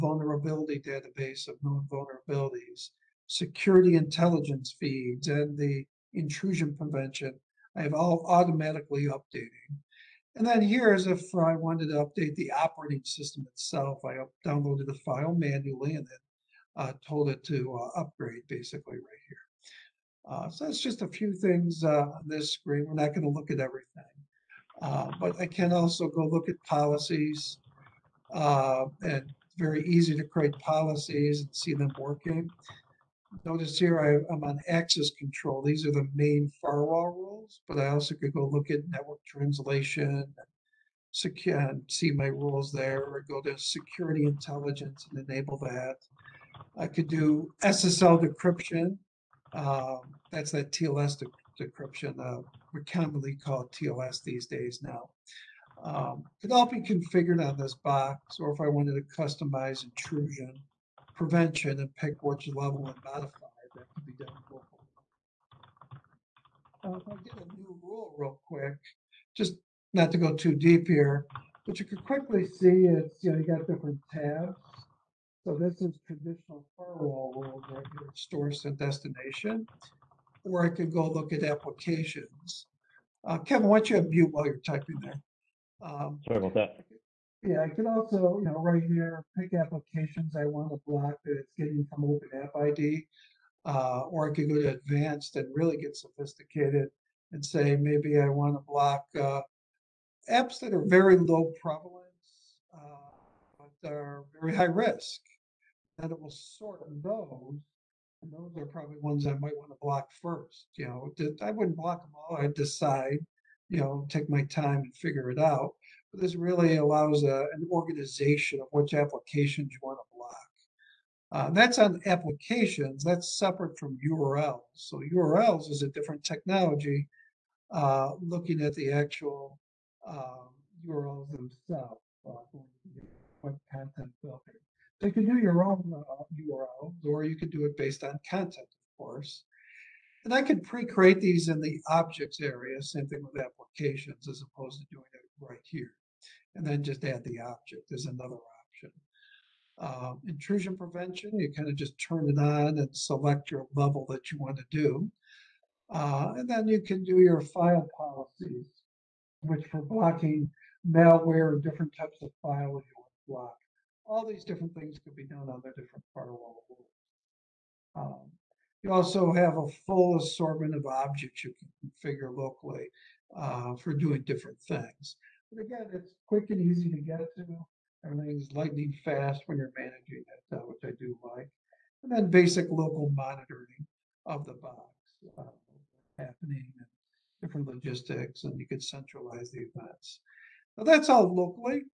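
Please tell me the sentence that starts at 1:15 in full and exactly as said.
So this is traditional firewall rules right here, source and destination or I could go look at applications.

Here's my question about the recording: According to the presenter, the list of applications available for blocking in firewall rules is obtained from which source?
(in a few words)
Open App ID.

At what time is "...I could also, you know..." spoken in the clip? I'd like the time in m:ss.
1:27.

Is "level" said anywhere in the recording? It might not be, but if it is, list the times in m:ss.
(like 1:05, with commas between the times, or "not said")
1:02, 2:33.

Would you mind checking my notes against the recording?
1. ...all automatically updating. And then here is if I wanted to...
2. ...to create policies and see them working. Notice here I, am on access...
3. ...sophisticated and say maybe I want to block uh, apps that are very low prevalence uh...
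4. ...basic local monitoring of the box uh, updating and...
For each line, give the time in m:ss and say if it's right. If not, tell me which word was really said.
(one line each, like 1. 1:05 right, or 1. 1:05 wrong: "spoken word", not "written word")
1. 0:07 right
2. 0:30 right
3. 1:35 right
4. 3:02 wrong: "happening", not "updating".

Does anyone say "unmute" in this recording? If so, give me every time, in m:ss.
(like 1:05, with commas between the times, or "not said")
1:24.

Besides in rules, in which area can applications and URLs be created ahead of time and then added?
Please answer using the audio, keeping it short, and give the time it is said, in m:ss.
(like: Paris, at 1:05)
objects area, at 2:21.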